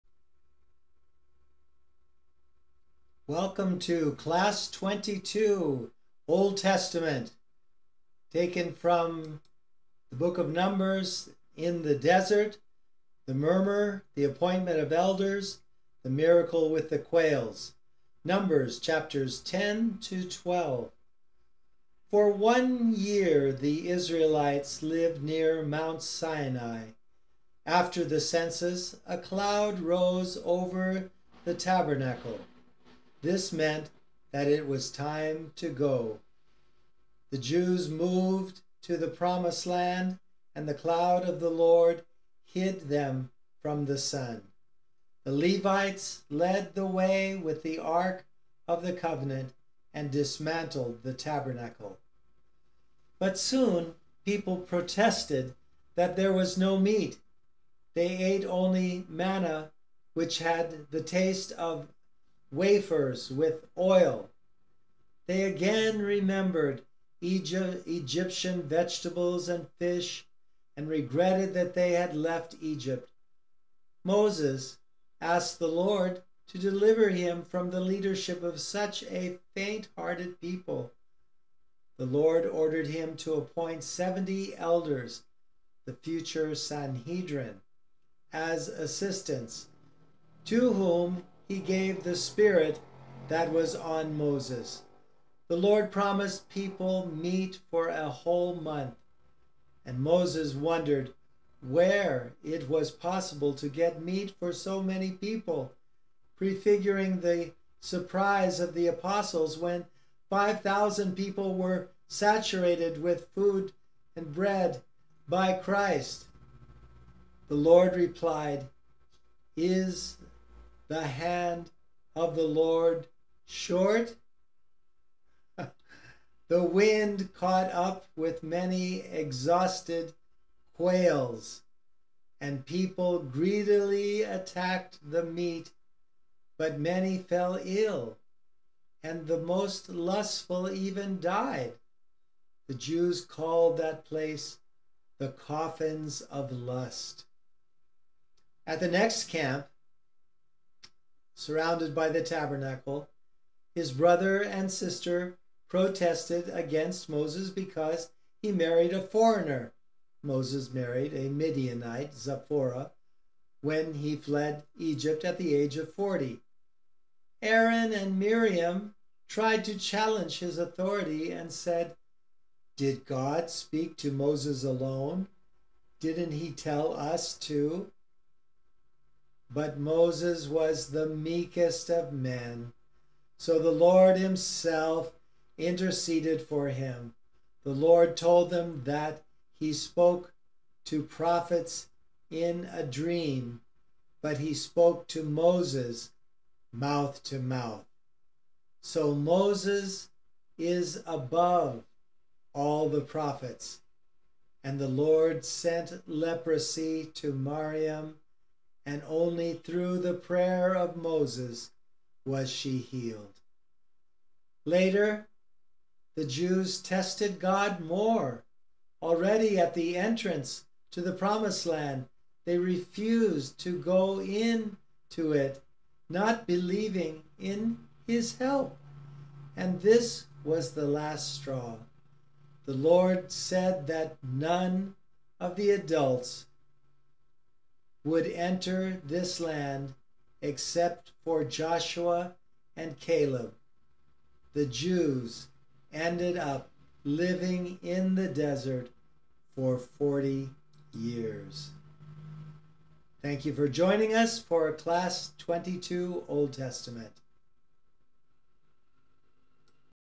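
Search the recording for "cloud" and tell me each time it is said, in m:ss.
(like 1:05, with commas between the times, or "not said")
0:29, 0:40.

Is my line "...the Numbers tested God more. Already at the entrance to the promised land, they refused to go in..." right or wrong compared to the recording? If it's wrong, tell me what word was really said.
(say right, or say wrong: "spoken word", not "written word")
wrong: "Jews", not "Numbers".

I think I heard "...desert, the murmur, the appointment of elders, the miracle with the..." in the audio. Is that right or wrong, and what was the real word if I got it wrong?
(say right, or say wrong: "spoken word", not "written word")
right.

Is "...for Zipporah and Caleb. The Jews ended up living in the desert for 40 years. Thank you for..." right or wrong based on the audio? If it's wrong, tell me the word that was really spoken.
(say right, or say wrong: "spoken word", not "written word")
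wrong: "Joshua", not "Zipporah".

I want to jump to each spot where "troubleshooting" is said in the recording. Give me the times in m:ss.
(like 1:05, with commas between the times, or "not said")
not said.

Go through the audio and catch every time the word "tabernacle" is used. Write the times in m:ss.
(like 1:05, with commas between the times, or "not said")
0:31, 0:51, 2:32.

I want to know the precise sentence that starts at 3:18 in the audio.
So Moses is above all the prophets.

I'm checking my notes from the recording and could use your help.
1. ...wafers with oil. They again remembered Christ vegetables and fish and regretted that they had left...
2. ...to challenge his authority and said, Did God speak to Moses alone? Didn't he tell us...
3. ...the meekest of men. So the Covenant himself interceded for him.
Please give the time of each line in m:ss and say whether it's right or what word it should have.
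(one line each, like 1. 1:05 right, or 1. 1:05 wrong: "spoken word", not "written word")
1. 1:02 wrong: "Egyptian", not "Christ"
2. 2:49 right
3. 3:00 wrong: "Lord", not "Covenant".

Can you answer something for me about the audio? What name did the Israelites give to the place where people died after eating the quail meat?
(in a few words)
The coffins of lust.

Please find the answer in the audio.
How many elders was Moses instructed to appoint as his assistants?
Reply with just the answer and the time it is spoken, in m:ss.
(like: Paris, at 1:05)
70, at 1:23.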